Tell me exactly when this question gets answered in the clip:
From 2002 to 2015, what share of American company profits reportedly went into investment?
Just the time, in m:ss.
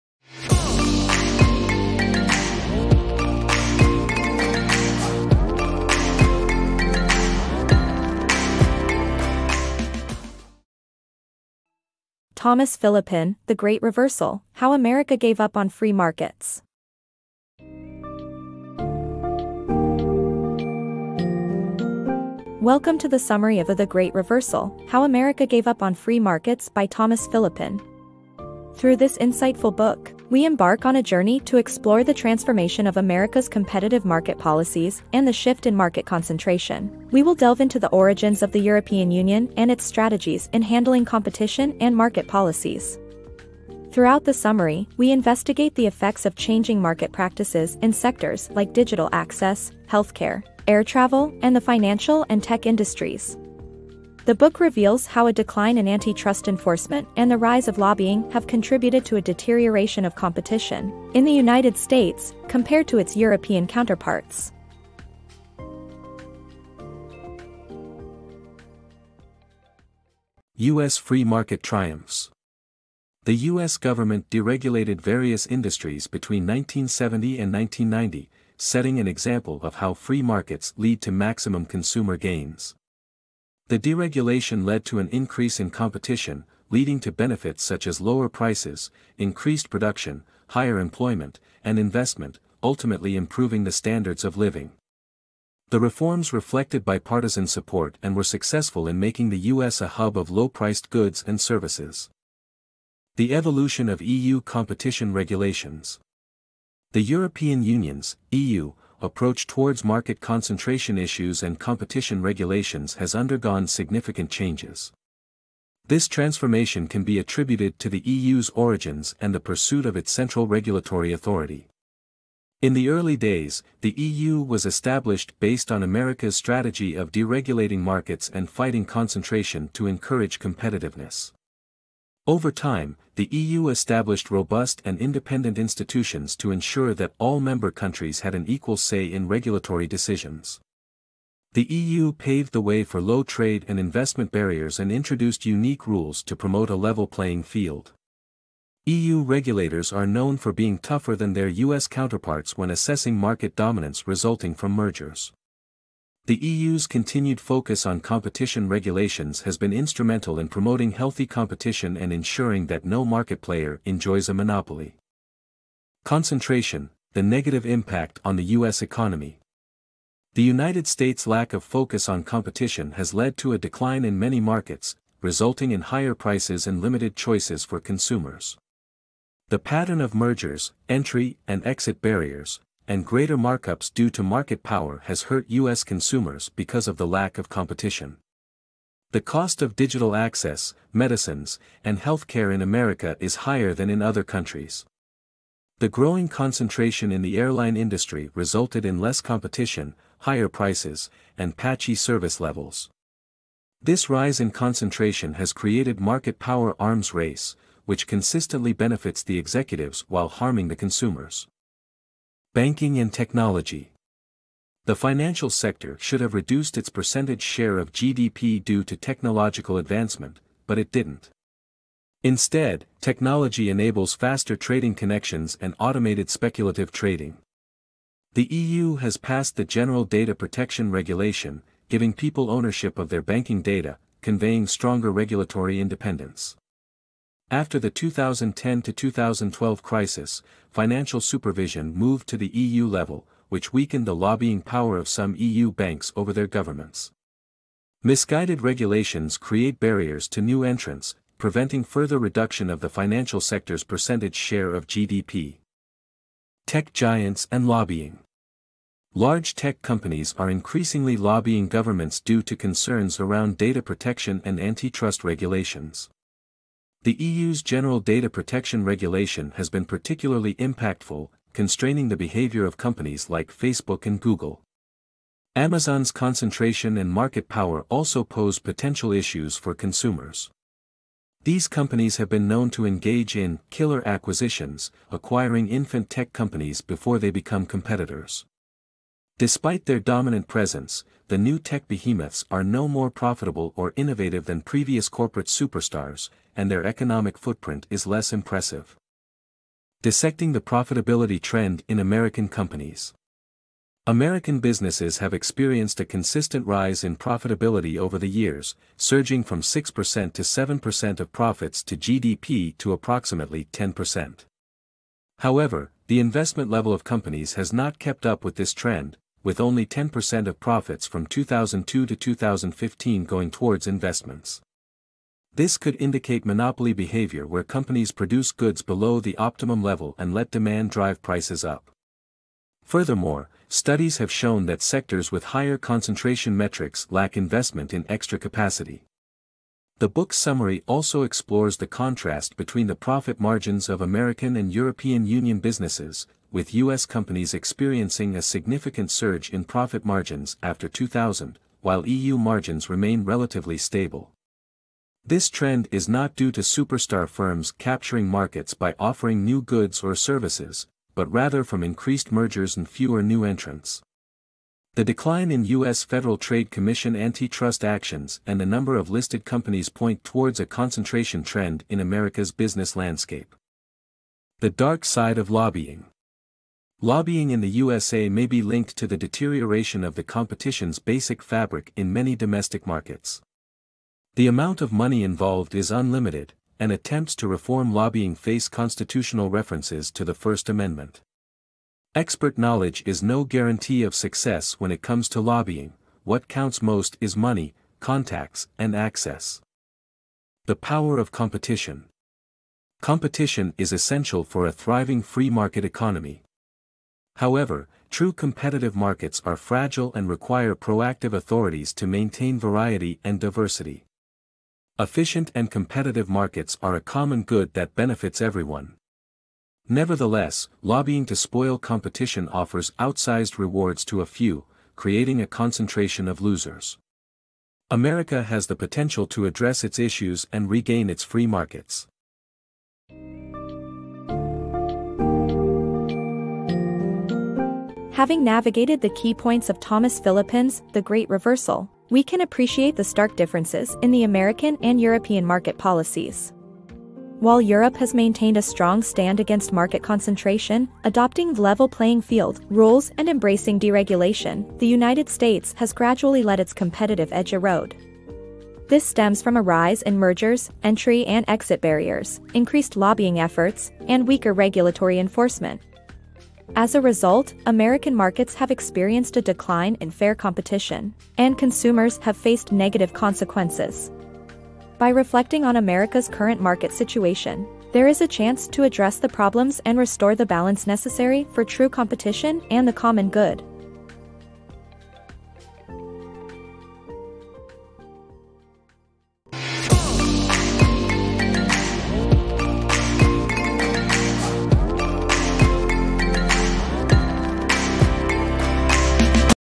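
5:19.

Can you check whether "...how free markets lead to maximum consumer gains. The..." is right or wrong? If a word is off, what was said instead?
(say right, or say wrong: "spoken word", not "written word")
right.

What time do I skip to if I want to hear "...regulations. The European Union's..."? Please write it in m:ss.
1:45.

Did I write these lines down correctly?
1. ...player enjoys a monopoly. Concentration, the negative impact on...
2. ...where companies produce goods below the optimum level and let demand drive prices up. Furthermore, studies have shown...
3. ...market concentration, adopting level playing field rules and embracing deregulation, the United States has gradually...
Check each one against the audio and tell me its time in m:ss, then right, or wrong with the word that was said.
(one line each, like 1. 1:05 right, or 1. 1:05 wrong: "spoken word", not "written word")
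1. 2:43 right
2. 5:27 right
3. 7:29 right.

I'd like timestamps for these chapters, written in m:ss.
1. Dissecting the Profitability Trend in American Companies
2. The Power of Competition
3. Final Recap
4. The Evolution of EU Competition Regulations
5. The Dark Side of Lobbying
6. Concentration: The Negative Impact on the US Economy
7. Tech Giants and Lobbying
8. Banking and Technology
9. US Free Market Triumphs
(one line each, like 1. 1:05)
1. 5:00
2. 6:41
3. 7:13
4. 1:43
5. 6:15
6. 2:46
7. 4:17
8. 3:33
9. 1:11.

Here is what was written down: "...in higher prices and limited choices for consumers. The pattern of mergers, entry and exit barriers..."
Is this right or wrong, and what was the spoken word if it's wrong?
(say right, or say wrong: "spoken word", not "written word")
right.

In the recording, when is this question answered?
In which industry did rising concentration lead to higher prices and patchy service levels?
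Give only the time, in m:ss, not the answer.
3:17.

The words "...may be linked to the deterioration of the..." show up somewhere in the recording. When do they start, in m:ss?
6:18.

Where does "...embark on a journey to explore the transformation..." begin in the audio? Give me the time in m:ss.
0:30.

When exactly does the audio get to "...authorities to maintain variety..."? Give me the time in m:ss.
6:51.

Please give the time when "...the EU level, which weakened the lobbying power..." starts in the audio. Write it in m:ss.
4:02.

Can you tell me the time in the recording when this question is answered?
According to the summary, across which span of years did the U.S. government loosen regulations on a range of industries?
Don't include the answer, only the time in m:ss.
1:16.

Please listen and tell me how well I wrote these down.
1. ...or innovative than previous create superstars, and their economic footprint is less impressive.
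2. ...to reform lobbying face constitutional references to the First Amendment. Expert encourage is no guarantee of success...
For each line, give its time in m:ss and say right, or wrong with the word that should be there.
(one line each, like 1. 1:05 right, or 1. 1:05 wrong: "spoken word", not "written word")
1. 4:53 wrong: "corporate", not "create"
2. 6:27 wrong: "knowledge", not "encourage".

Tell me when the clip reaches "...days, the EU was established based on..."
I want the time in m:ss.
2:03.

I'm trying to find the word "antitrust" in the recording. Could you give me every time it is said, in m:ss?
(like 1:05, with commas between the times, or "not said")
0:55, 4:24, 6:07.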